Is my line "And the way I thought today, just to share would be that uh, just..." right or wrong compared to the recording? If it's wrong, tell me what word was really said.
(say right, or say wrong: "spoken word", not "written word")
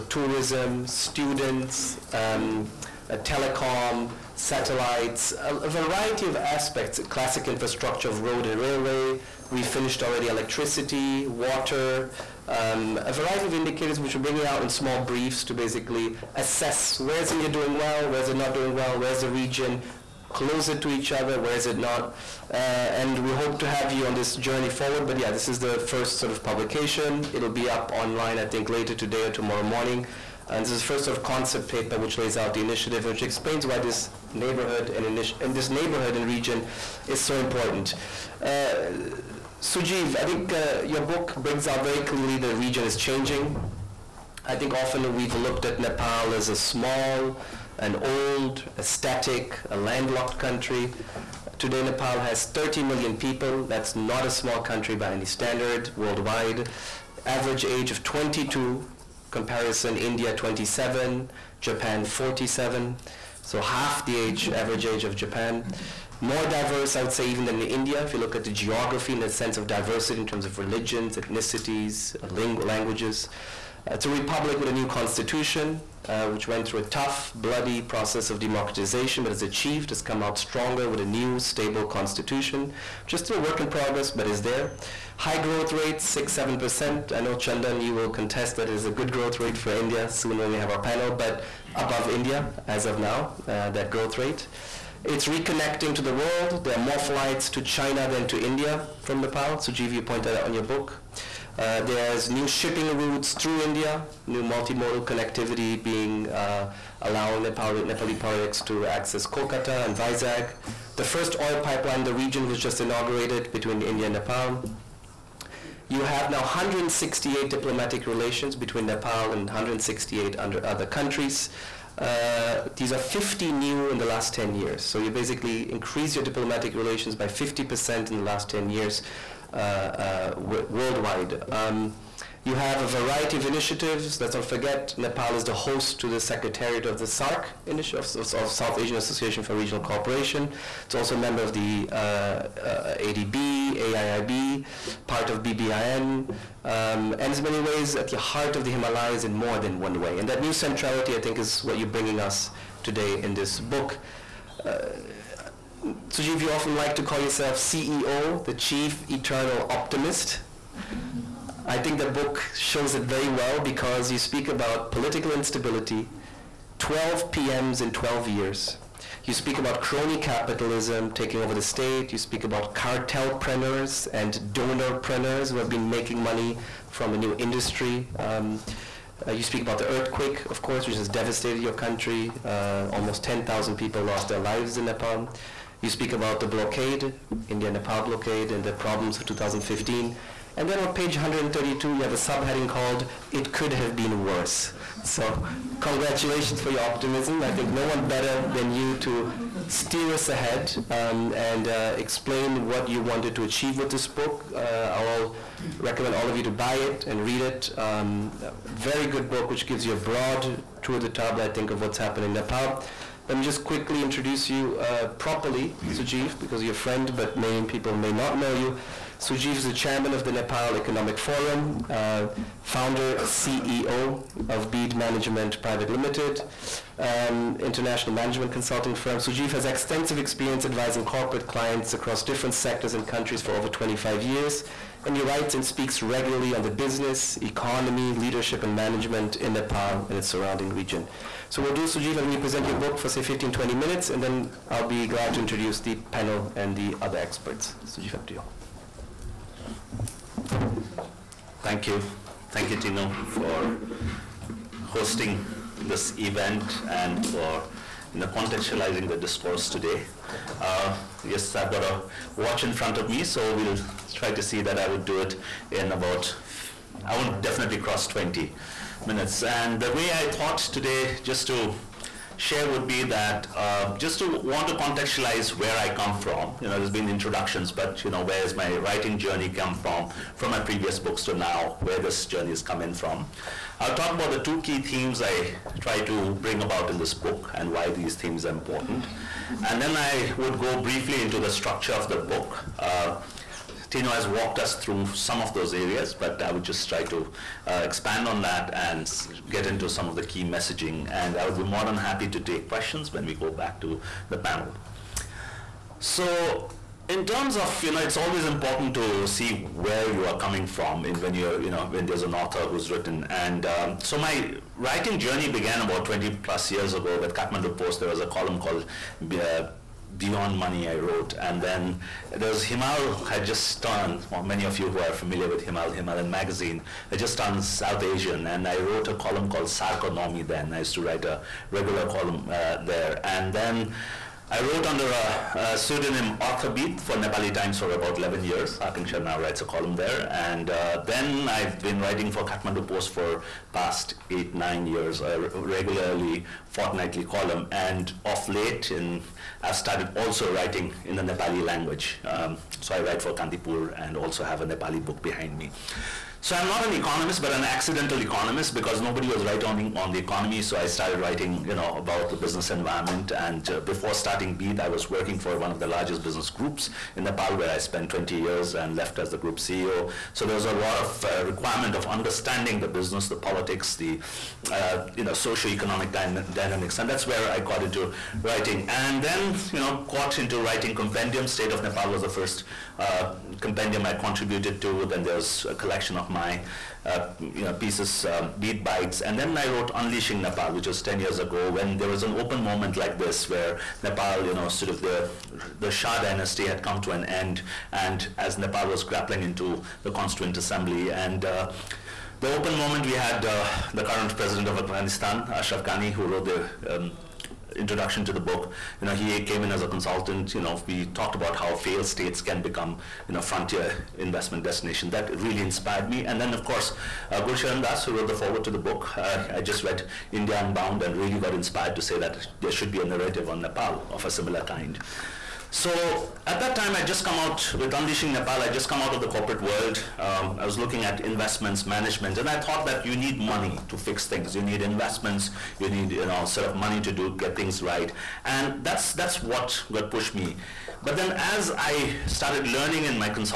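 right.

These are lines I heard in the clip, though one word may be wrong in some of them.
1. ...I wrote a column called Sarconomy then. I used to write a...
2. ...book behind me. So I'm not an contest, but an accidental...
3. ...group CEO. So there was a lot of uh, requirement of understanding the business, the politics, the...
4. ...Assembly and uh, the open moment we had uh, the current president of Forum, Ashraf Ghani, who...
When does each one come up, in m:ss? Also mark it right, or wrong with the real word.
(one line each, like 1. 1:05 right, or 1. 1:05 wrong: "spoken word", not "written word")
1. 5:28 right
2. 5:55 wrong: "economist", not "contest"
3. 6:09 right
4. 6:40 wrong: "Afghanistan", not "Forum".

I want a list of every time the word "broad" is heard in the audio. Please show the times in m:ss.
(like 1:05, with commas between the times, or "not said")
3:30.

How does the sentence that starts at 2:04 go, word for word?
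So you basically increase your diplomatic relations by 50% in the last 10 years uh, uh, worldwide.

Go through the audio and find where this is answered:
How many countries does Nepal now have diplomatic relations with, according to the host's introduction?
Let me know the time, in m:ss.
1:56.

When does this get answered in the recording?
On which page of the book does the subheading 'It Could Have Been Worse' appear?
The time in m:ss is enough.
3:10.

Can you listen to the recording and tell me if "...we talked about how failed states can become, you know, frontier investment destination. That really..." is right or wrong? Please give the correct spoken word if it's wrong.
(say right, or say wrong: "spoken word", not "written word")
right.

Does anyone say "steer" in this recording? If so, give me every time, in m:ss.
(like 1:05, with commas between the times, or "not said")
3:19.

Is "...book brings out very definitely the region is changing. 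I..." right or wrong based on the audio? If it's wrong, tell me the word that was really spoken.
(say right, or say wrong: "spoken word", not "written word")
wrong: "clearly", not "definitely".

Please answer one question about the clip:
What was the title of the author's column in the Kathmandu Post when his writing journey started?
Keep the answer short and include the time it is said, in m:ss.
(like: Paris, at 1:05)
Beyond Money, at 5:20.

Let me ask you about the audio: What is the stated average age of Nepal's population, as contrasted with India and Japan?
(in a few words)
22.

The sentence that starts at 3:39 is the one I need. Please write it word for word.
Sujeev is the chairman of the Nepal Economic Forum, uh, founder, CEO of Beed Management Private Limited, um, international management consulting firm.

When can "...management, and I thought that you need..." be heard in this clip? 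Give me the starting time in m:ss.
7:11.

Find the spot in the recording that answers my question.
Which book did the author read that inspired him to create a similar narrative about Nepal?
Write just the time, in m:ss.
7:00.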